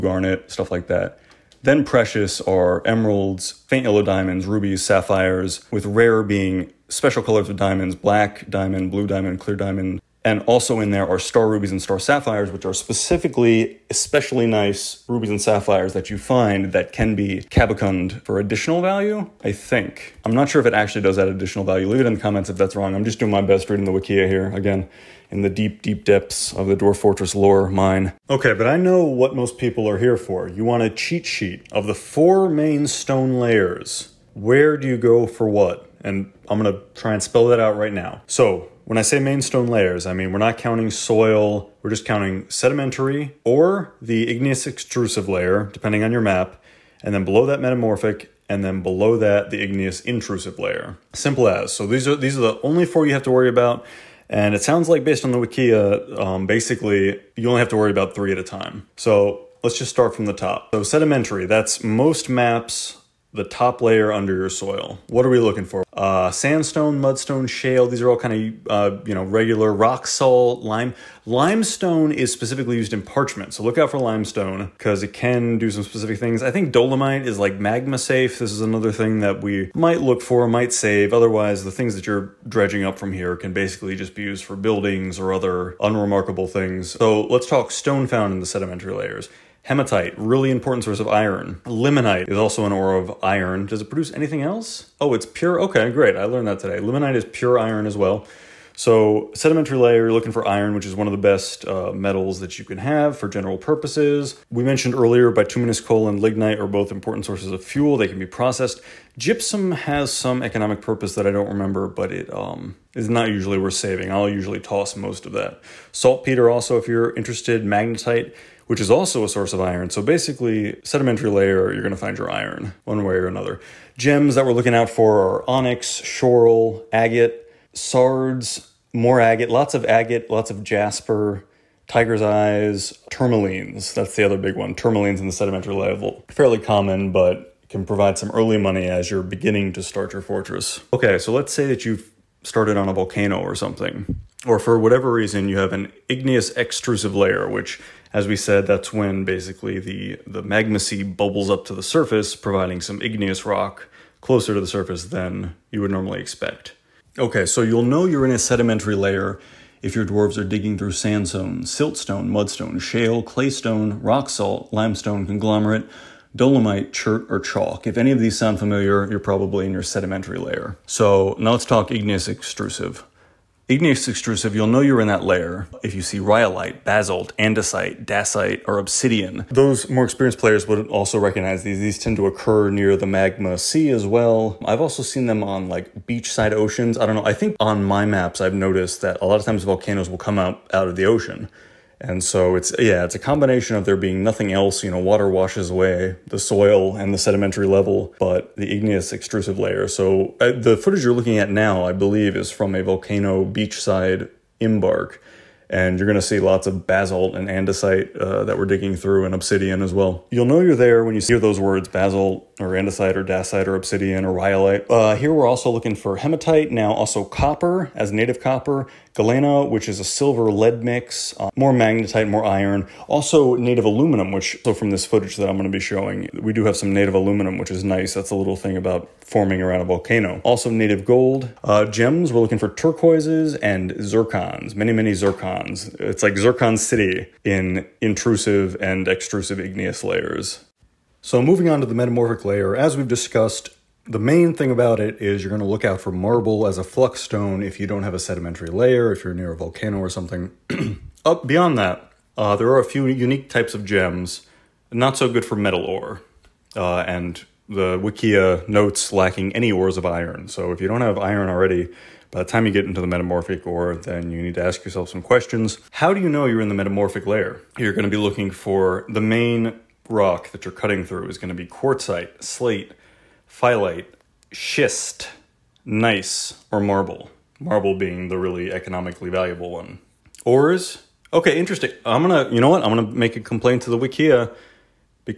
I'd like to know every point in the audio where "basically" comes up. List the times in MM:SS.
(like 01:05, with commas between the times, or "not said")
00:56, 01:23, 02:00, 02:29.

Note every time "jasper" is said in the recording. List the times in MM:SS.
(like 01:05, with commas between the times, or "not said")
02:10.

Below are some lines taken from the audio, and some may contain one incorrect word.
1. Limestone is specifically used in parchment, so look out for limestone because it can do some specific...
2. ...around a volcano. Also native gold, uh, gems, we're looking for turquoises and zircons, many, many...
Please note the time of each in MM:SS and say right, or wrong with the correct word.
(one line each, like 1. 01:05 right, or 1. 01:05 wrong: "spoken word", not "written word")
1. 01:11 right
2. 03:49 right.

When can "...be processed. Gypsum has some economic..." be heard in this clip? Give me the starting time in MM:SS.
01:48.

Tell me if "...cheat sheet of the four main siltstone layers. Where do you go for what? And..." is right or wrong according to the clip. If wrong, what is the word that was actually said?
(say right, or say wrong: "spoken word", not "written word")
wrong: "stone", not "siltstone".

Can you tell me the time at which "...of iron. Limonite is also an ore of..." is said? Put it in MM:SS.
01:30.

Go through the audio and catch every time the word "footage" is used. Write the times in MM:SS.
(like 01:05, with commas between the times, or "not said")
03:20, 03:45.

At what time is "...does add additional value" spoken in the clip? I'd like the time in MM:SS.
00:21.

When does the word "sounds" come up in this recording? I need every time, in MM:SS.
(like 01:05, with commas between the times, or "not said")
00:54, 02:48.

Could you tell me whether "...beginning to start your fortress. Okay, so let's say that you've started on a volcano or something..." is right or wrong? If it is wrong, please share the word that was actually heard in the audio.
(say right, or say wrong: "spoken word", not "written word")
right.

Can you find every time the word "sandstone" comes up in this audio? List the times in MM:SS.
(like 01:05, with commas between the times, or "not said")
01:06, 02:40.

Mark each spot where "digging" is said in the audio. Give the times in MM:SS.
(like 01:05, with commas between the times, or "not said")
02:40, 03:28.